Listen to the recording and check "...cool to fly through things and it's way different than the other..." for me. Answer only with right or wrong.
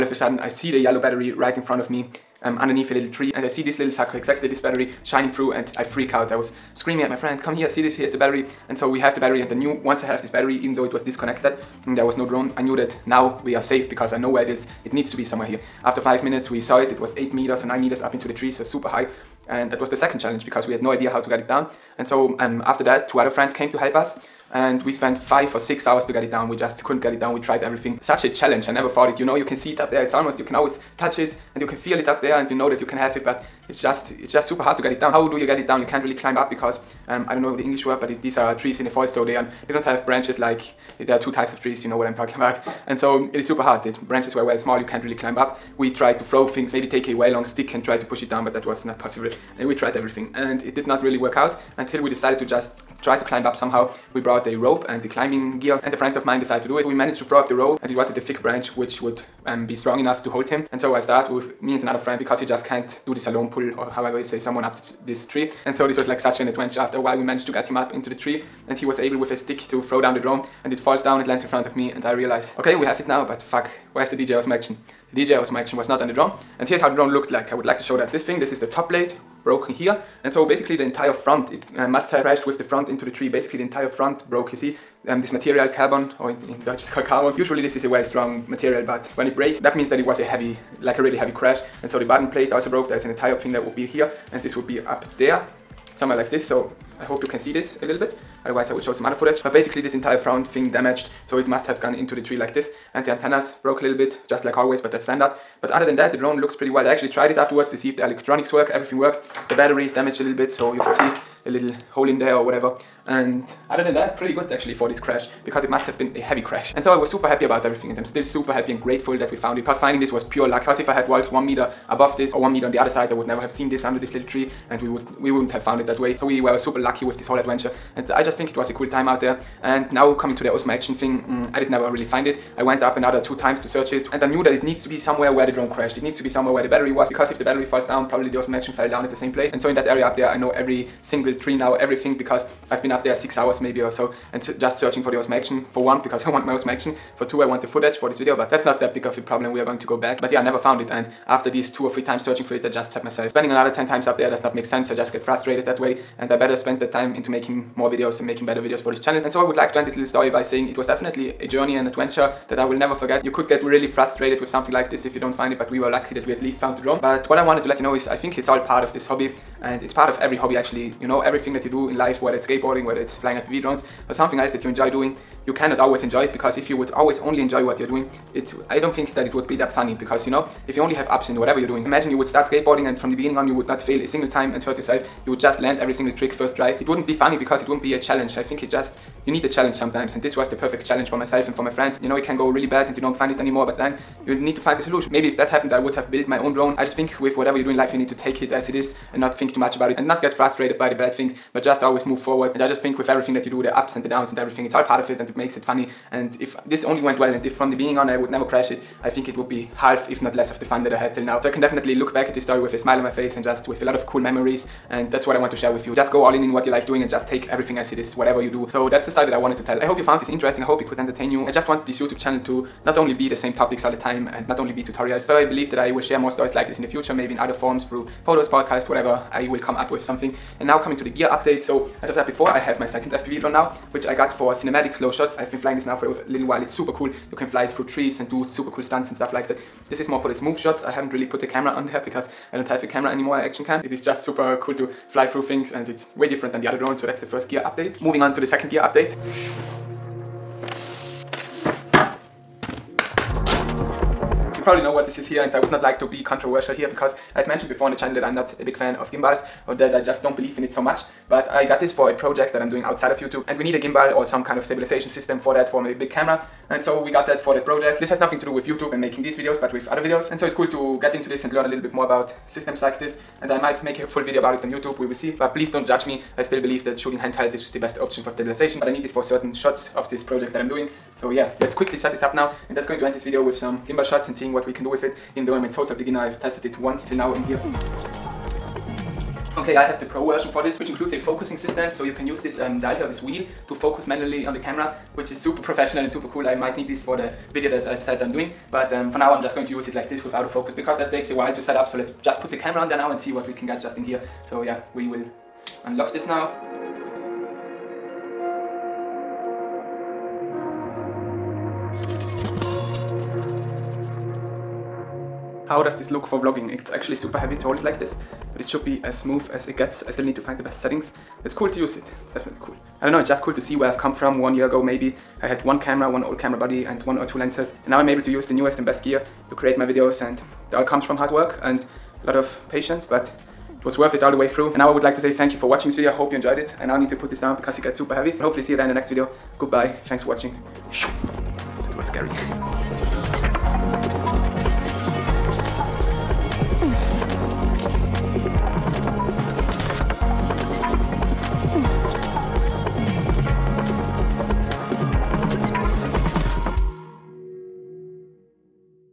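right.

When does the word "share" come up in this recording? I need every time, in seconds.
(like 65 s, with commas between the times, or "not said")
215 s, 226 s.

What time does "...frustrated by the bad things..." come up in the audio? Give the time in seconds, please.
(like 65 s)
200 s.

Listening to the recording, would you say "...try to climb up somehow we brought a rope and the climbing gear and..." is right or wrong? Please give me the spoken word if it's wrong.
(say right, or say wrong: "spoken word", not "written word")
right.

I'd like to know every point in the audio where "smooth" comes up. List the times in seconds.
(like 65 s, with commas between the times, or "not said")
240 s, 319 s.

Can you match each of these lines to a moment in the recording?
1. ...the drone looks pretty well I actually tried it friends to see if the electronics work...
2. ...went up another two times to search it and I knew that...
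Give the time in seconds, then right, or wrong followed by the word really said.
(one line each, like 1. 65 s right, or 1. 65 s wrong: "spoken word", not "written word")
1. 106 s wrong: "afterwards", not "friends"
2. 132 s right.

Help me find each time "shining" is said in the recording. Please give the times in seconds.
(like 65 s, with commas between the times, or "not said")
5 s.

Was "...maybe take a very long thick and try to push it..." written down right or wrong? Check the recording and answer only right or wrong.
wrong.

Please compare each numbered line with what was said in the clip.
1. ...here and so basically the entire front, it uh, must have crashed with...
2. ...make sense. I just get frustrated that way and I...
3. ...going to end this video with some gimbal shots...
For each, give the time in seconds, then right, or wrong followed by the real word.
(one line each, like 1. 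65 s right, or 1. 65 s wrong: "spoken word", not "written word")
1. 79 s right
2. 154 s right
3. 282 s right.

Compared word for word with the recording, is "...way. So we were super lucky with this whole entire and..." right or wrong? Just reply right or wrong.
wrong.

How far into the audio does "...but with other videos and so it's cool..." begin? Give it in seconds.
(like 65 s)
269 s.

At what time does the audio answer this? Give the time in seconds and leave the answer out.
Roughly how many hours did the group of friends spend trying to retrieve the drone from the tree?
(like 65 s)
25 s.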